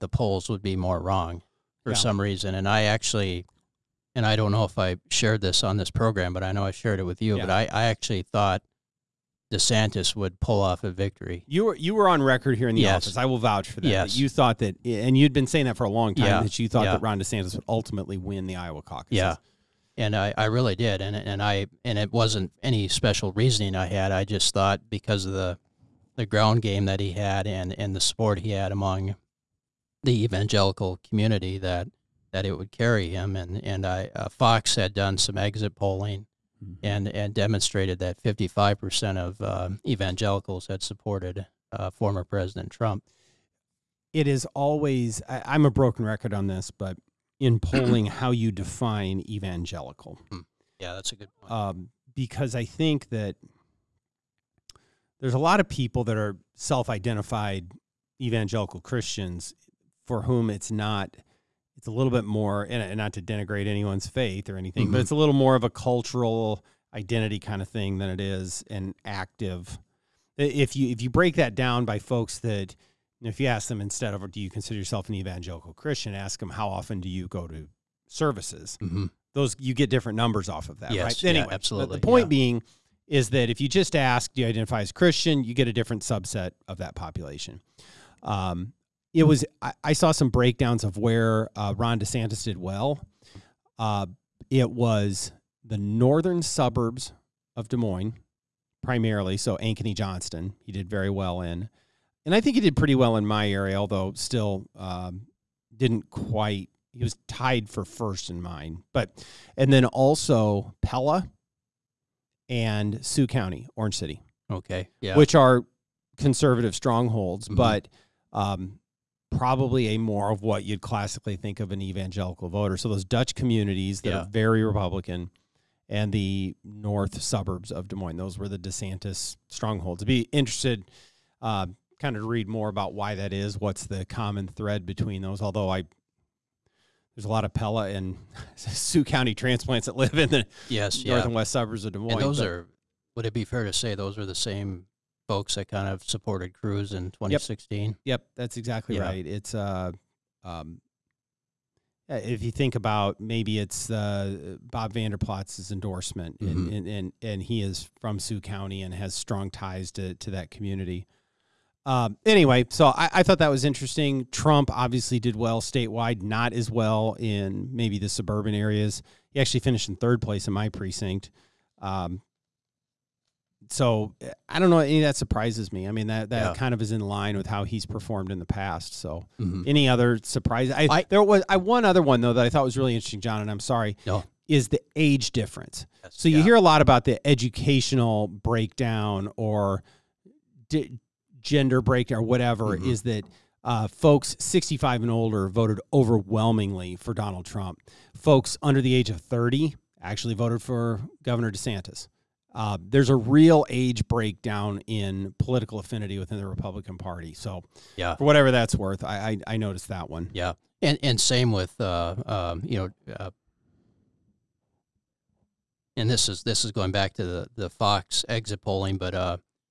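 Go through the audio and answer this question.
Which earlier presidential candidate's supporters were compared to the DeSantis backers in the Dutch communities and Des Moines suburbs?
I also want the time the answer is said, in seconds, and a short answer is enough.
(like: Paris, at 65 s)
Cruz, at 146 s.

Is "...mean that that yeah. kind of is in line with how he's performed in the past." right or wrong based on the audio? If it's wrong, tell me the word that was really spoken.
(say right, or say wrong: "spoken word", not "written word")
right.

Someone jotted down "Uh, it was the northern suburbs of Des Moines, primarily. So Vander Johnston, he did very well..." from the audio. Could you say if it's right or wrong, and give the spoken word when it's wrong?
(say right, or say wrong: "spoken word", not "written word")
wrong: "Ankeny", not "Vander".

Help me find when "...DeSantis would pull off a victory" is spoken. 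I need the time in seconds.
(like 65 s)
9 s.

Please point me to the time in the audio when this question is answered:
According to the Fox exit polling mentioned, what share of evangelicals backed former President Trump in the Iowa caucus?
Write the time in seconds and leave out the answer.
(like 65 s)
38 s.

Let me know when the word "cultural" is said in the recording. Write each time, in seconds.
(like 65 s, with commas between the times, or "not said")
65 s.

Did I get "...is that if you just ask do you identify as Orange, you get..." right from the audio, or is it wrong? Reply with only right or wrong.
wrong.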